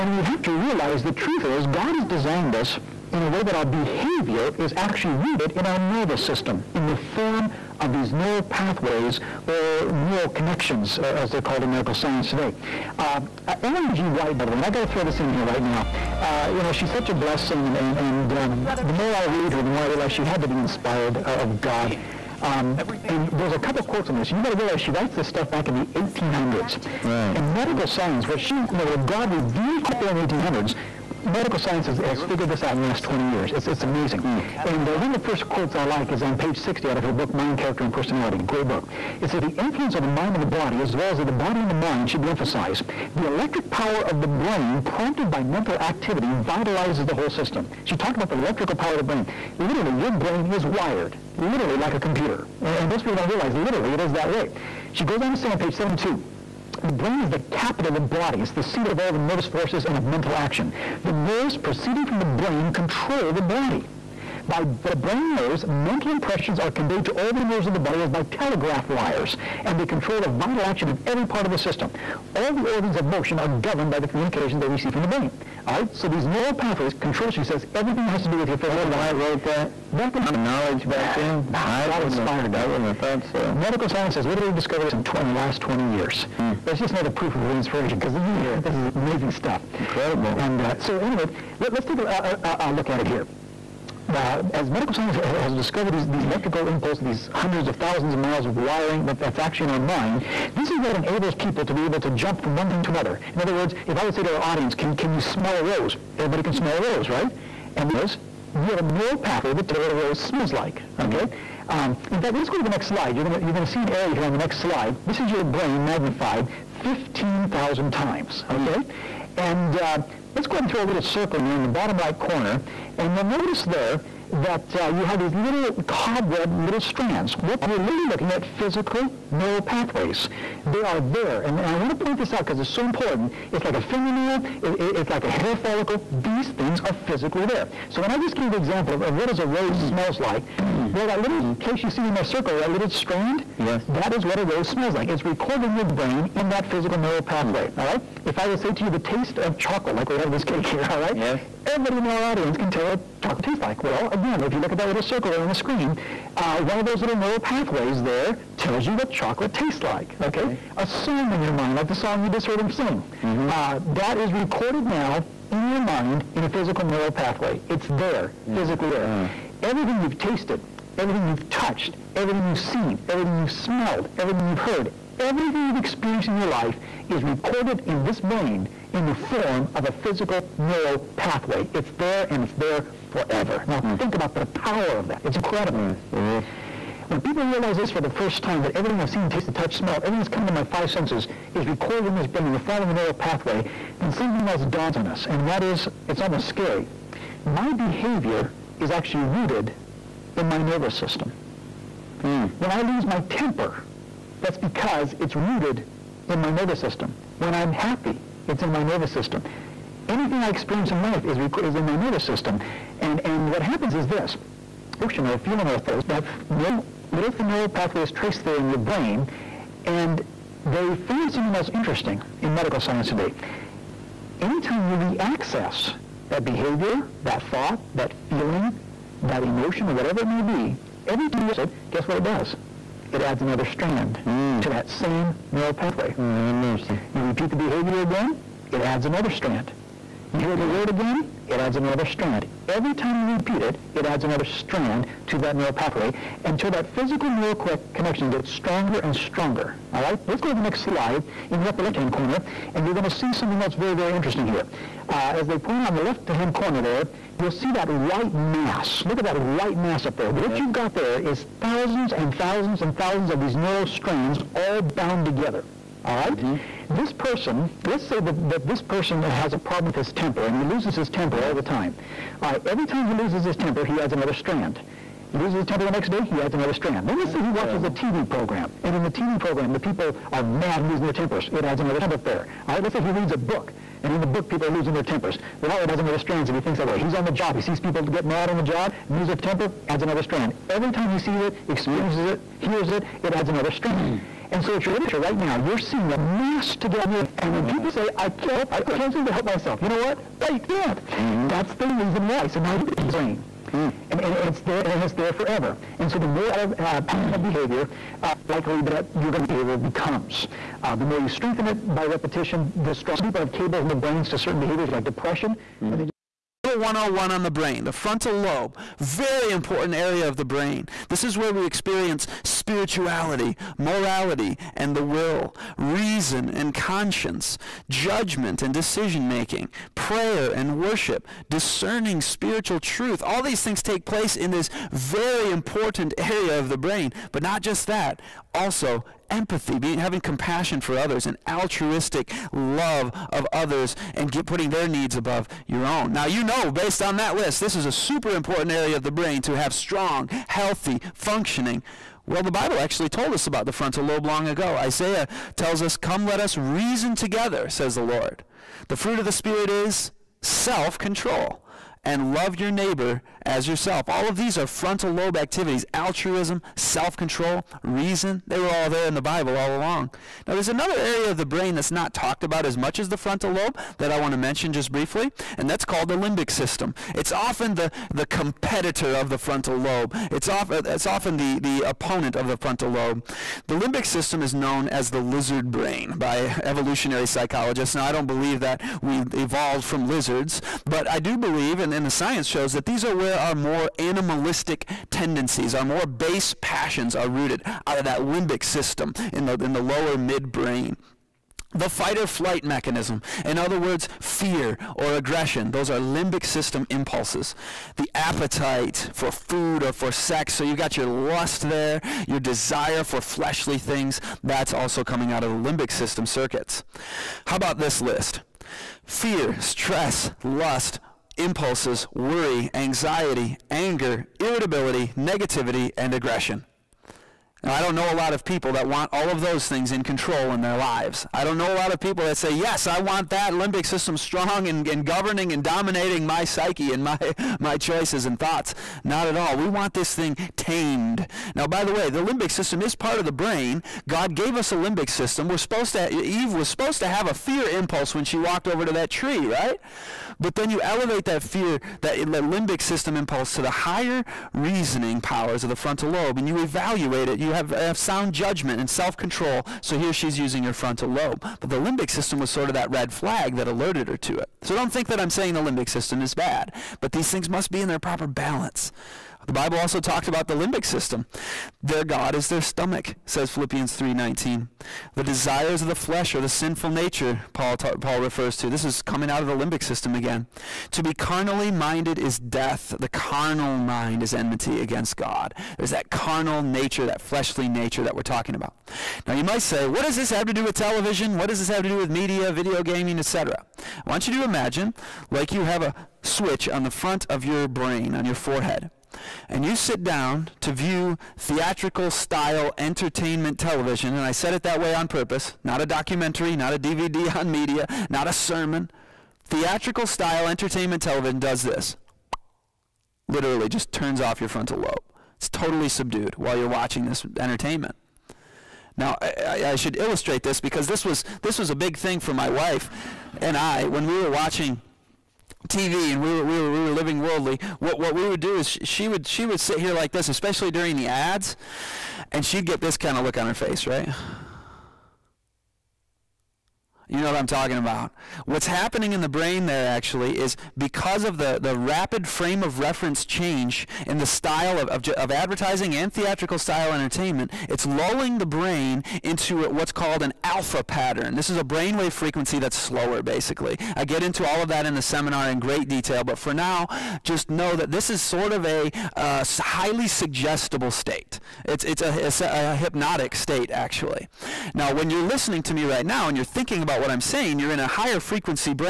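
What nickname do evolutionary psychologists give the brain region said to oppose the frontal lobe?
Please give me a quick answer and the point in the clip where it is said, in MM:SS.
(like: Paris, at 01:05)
Lizard brain, at 06:25.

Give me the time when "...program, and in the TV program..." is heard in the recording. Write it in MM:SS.
04:38.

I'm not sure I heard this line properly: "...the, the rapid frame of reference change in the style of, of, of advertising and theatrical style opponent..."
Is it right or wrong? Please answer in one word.
wrong.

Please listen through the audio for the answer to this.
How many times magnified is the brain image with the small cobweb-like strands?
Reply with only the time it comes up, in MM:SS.
01:56.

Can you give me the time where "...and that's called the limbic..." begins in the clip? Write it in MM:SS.
06:15.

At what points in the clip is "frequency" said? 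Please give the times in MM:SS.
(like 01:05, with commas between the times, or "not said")
09:12, 09:28.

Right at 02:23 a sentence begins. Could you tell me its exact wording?
that is what a rose smells like.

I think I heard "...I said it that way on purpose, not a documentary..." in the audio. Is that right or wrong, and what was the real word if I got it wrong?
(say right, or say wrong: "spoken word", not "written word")
right.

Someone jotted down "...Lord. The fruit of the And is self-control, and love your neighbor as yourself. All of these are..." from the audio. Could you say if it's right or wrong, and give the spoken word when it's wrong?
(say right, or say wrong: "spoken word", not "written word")
wrong: "Spirit", not "And".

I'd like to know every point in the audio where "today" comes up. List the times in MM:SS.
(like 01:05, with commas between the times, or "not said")
00:12, 03:43.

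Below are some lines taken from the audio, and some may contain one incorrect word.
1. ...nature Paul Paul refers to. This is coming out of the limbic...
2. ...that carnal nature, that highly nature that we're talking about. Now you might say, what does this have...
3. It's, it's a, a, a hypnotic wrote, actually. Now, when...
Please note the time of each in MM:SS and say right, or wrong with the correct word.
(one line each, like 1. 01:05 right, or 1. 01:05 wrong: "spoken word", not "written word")
1. 07:56 right
2. 08:05 wrong: "fleshly", not "highly"
3. 09:21 wrong: "state", not "wrote".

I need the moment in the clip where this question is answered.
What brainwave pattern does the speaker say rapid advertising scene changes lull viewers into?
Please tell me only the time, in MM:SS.
09:10.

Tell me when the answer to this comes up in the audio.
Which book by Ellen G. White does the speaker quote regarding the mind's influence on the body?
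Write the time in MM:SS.
00:37.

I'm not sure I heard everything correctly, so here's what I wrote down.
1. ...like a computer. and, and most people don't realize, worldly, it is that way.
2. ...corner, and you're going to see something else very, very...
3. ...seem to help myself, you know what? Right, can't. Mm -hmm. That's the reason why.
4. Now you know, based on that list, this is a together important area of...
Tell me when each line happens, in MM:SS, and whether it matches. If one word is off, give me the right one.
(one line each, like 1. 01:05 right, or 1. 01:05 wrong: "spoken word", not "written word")
1. 00:51 wrong: "literally", not "worldly"
2. 04:12 right
3. 04:59 right
4. 05:46 wrong: "super", not "together".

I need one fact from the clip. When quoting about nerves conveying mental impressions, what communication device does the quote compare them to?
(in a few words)
Telegraph wires.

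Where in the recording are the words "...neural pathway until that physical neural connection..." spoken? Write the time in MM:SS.
04:05.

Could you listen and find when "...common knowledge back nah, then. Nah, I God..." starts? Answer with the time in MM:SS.
01:20.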